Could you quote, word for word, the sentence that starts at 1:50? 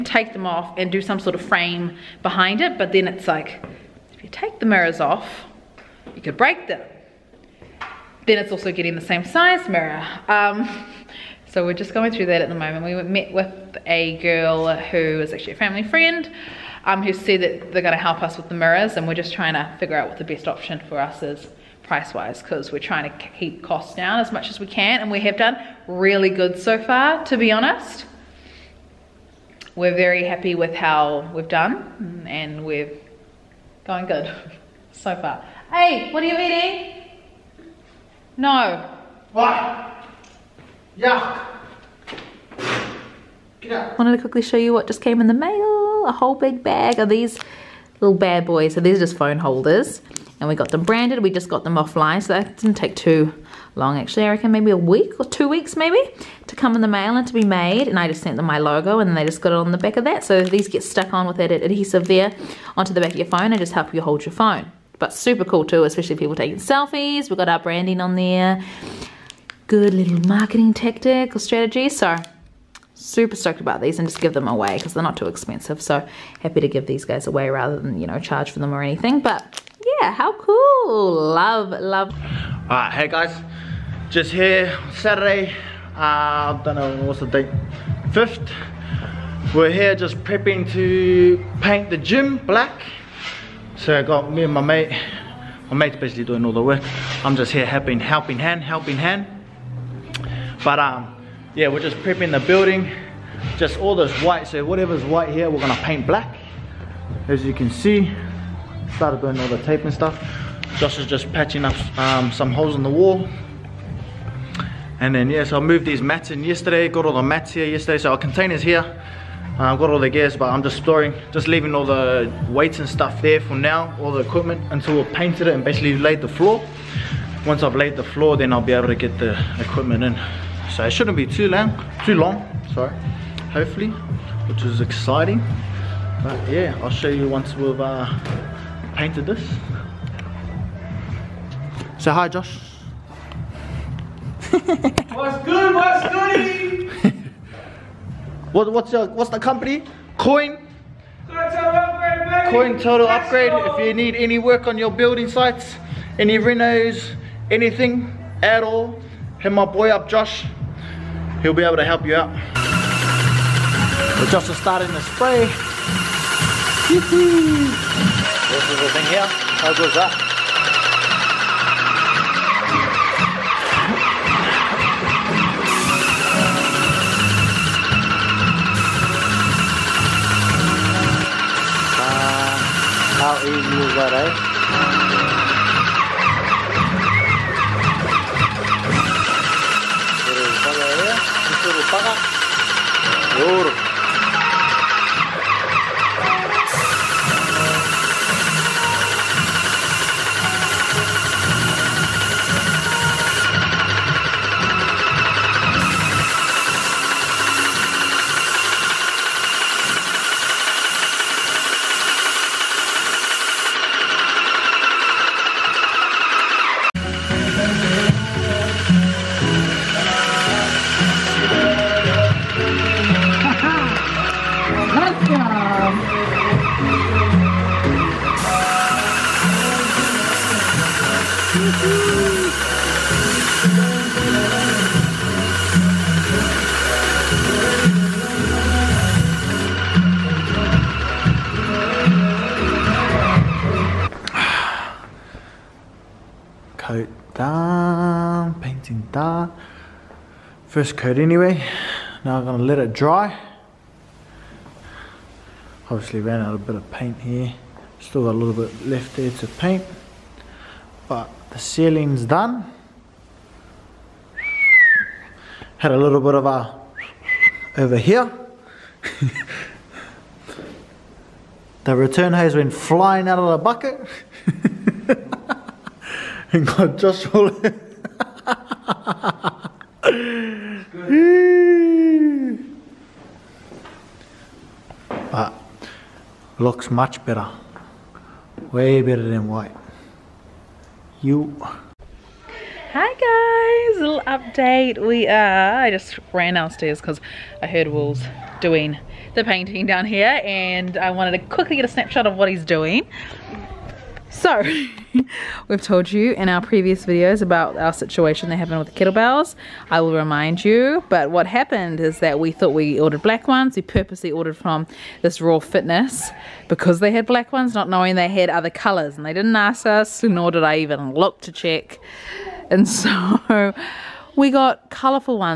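Josh is just patching up um, some holes in the wall.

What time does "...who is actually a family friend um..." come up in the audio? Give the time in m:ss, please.
0:14.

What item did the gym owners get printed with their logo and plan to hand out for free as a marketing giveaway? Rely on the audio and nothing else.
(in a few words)
Phone holders.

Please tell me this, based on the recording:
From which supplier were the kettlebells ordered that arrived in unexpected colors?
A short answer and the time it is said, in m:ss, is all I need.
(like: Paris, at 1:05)
Raw Fitness, at 5:15.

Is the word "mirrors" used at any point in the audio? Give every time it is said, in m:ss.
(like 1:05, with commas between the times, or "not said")
0:04, 0:09, 0:18.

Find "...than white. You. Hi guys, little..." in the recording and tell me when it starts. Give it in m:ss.
4:49.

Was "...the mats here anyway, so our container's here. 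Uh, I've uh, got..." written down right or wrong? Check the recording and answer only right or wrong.
wrong.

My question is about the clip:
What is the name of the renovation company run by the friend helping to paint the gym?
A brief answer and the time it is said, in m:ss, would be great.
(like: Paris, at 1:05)
Coin Total Upgrade, at 2:32.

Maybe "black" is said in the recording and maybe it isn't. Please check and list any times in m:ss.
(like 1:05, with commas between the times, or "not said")
1:32, 1:46, 5:13, 5:17.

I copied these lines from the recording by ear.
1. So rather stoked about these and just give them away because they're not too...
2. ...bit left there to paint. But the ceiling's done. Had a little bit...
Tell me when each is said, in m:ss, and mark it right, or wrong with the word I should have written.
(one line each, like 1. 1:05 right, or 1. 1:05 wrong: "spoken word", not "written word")
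1. 1:11 wrong: "super", not "rather"
2. 4:18 right.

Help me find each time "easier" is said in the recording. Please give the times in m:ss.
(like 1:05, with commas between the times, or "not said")
not said.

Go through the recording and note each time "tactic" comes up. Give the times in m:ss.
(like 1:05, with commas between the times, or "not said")
1:10.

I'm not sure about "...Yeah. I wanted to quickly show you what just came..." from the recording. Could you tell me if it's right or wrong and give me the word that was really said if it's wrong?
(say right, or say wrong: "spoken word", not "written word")
right.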